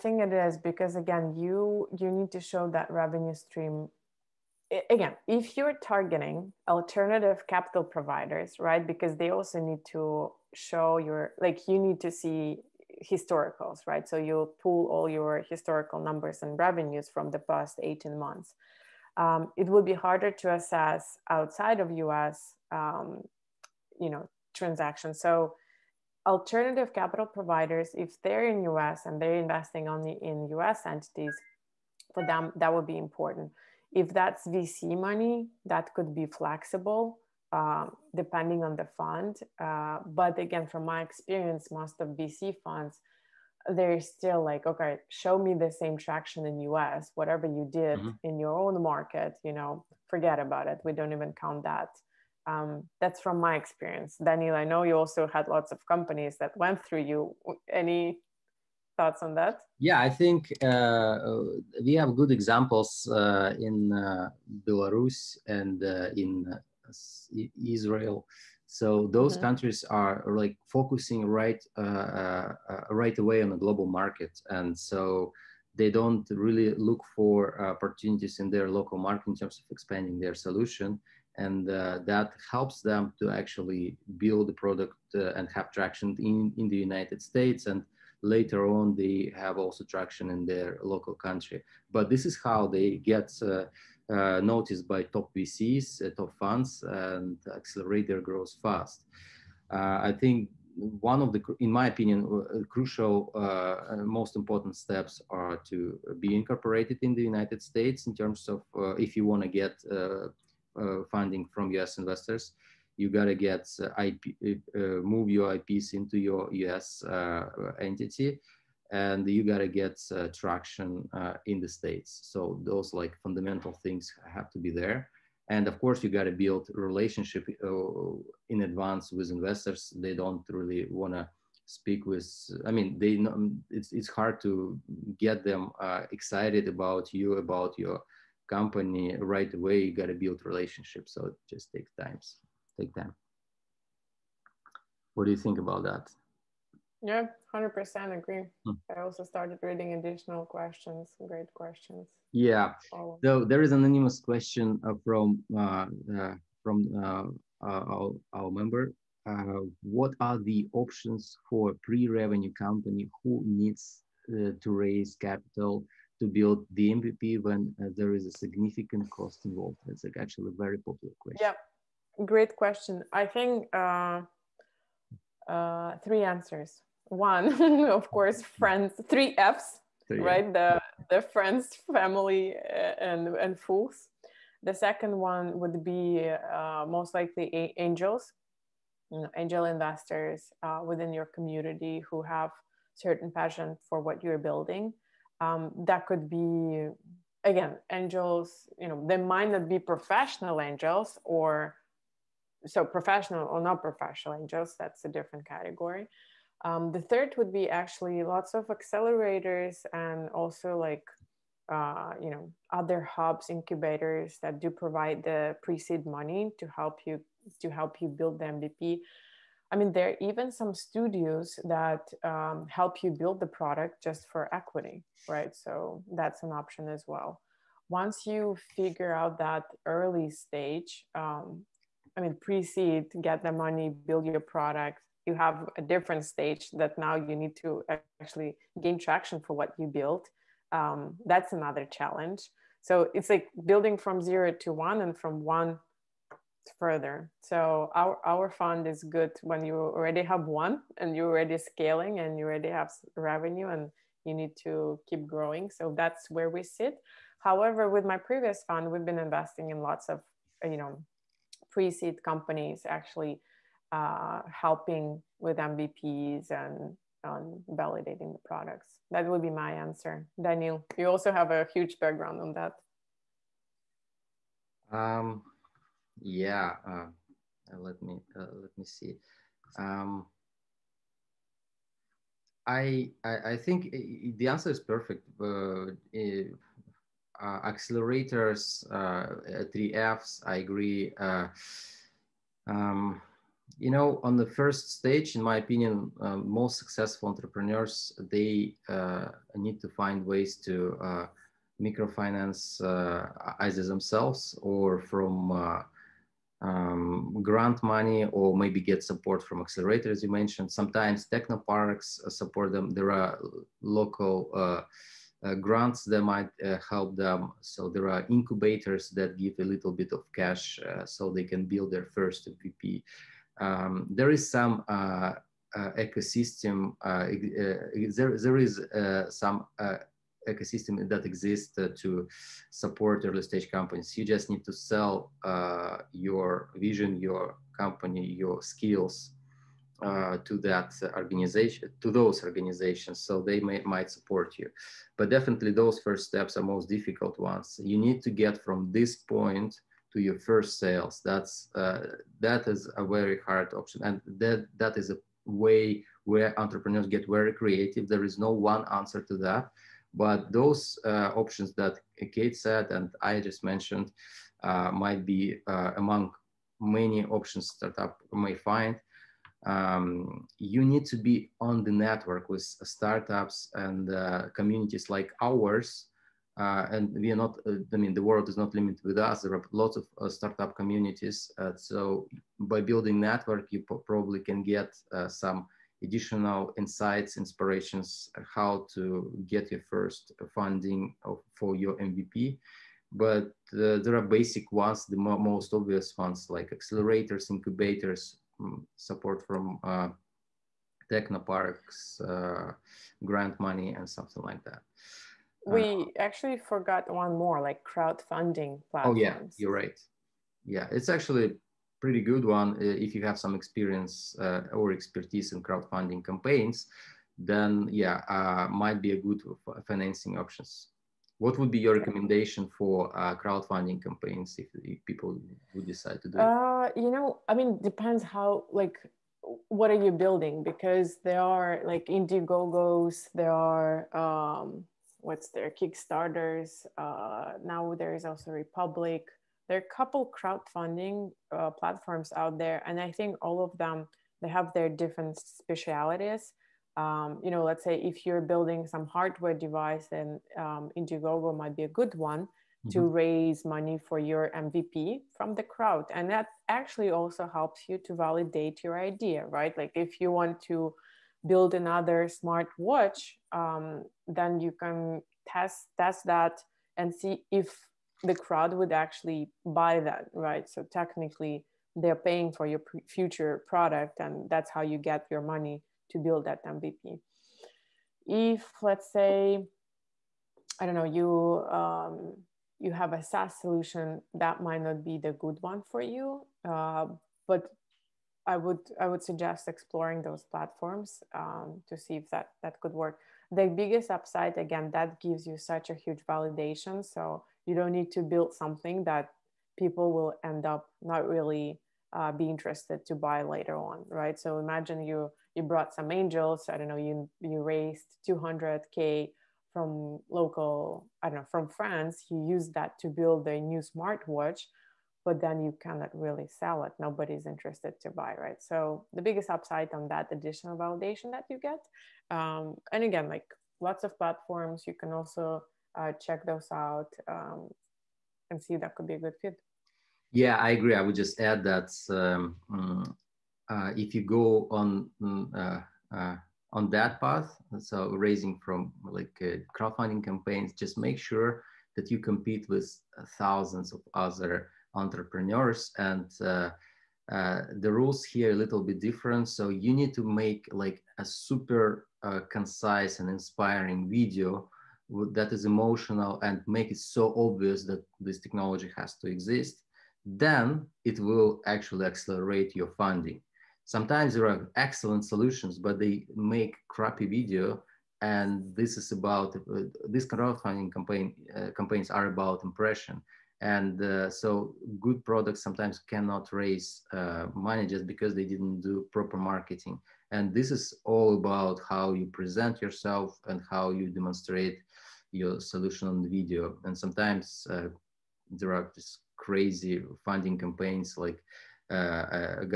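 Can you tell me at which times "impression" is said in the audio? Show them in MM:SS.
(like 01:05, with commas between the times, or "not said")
09:32.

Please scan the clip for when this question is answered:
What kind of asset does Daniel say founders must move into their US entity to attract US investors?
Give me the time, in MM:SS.
01:55.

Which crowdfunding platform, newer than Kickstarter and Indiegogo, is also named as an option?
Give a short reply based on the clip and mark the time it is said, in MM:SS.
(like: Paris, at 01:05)
Republic, at 07:18.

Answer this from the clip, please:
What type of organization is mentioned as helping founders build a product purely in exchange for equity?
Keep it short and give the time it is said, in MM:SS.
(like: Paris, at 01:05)
Studios, at 03:40.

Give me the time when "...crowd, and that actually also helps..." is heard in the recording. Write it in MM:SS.
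07:35.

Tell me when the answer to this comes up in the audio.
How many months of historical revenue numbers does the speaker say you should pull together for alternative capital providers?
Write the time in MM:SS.
00:17.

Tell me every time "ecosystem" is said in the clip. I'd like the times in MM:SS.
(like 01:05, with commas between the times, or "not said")
05:25, 05:30.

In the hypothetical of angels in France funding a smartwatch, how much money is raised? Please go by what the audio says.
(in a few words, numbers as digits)
200k.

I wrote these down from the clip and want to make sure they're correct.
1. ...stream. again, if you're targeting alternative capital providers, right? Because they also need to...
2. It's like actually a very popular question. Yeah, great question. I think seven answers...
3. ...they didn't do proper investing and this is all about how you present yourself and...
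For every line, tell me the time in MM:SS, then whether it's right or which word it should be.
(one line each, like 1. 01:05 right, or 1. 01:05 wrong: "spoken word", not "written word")
1. 00:03 right
2. 02:49 wrong: "three", not "seven"
3. 09:38 wrong: "marketing", not "investing".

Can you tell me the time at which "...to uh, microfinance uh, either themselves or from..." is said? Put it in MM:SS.
05:00.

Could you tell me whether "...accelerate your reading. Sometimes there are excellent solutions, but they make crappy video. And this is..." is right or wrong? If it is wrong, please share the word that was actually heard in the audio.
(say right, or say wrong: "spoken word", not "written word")
wrong: "funding", not "reading".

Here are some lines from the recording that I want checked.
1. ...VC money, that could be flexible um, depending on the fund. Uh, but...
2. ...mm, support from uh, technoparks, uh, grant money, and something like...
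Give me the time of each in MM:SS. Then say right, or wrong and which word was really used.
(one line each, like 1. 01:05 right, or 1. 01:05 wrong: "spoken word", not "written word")
1. 00:34 right
2. 06:38 right.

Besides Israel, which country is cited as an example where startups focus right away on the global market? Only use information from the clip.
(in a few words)
Belarus.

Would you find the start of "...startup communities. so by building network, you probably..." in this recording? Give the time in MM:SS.
06:20.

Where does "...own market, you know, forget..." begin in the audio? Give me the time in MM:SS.
00:48.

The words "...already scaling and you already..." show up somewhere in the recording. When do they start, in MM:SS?
04:11.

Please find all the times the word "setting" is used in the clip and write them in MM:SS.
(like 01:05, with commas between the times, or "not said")
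not said.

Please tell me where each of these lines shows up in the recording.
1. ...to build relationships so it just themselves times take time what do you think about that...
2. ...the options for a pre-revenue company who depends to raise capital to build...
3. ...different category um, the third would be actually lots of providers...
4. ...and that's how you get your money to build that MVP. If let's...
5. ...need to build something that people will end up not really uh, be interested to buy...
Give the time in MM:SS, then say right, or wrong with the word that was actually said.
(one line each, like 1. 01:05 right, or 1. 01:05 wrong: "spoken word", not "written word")
1. 02:20 wrong: "takes", not "themselves"
2. 02:40 wrong: "needs", not "depends"
3. 03:25 wrong: "accelerators", not "providers"
4. 07:54 right
5. 08:17 right.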